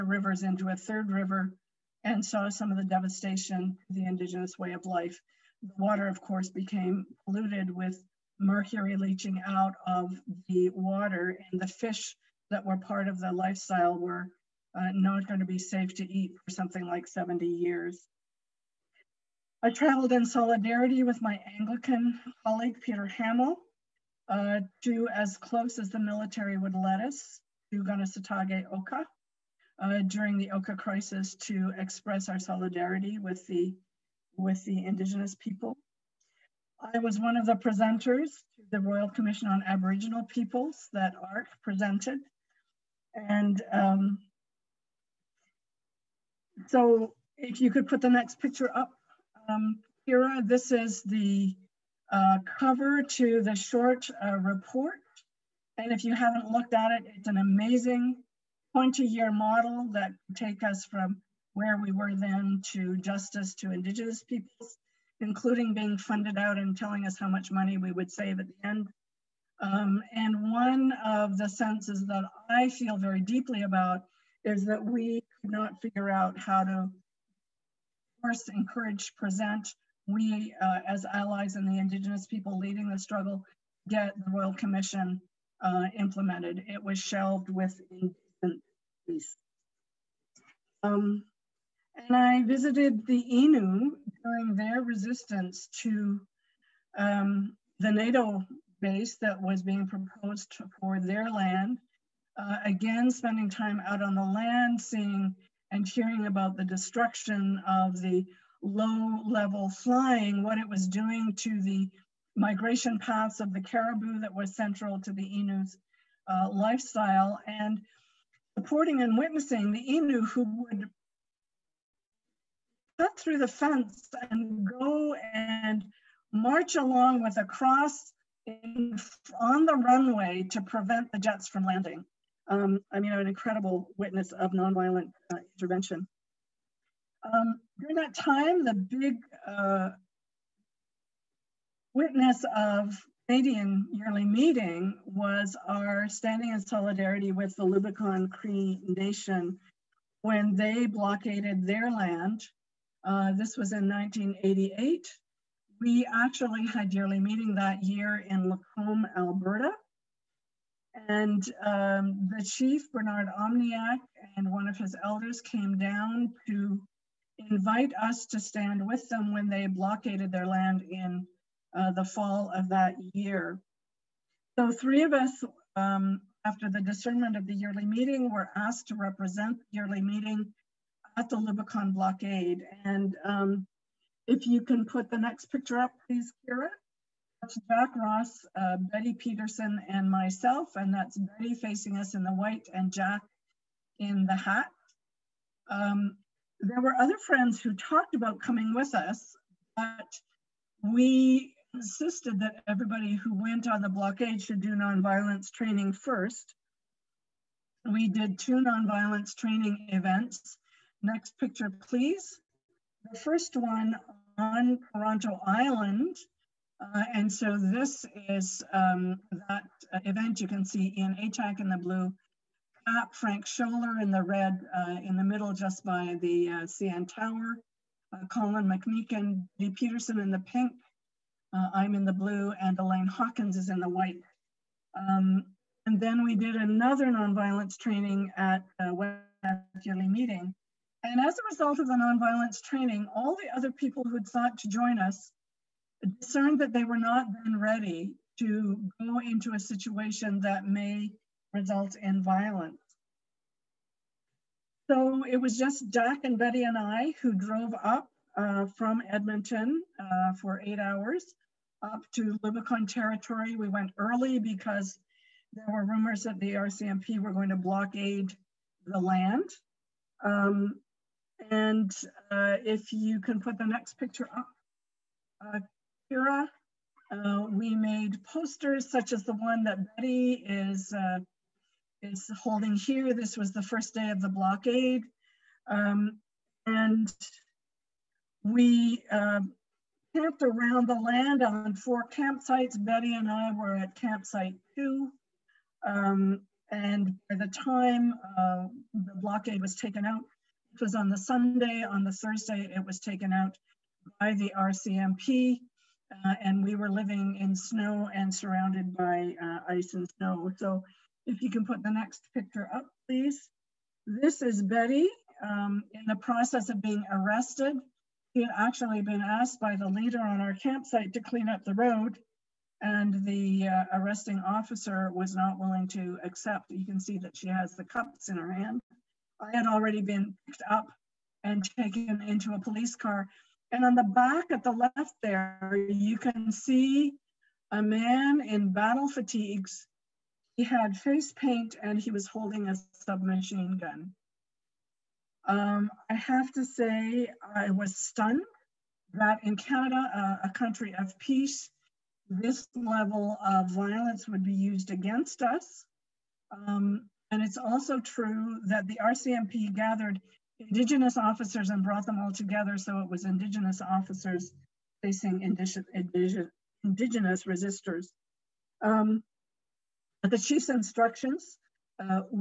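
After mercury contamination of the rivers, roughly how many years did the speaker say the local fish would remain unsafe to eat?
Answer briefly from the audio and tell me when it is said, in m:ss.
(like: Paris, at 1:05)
70, at 0:17.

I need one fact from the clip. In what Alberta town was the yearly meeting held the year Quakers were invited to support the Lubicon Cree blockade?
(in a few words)
Lacombe.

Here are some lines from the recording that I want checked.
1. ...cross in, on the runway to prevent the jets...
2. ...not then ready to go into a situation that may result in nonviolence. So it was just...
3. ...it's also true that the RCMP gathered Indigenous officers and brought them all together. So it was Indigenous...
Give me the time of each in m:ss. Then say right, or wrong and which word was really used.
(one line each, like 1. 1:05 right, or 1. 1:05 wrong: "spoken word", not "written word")
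1. 2:07 right
2. 4:06 wrong: "violence", not "nonviolence"
3. 5:57 right.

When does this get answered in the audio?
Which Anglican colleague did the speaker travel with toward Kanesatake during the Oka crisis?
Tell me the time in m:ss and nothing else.
0:22.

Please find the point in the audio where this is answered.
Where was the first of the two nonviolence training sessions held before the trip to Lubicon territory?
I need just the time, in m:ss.
3:34.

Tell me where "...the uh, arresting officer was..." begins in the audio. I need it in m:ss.
5:23.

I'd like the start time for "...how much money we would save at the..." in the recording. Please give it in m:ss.
1:07.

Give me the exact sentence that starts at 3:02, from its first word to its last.
And um, if you can put the next picture up, please, Kira.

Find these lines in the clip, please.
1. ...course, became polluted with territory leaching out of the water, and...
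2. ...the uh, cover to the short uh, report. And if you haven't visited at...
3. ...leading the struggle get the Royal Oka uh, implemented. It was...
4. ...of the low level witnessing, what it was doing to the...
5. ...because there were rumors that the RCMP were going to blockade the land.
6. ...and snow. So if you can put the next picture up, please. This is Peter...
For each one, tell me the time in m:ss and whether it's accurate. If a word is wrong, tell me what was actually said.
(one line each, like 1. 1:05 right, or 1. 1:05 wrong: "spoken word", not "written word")
1. 0:06 wrong: "mercury", not "territory"
2. 0:51 wrong: "looked", not "visited"
3. 1:22 wrong: "Commission", not "Oka"
4. 1:47 wrong: "flying", not "witnessing"
5. 4:24 right
6. 5:09 wrong: "Betty", not "Peter".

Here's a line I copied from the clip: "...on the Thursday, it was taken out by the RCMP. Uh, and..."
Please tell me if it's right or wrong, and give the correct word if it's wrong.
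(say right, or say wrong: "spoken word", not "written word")
right.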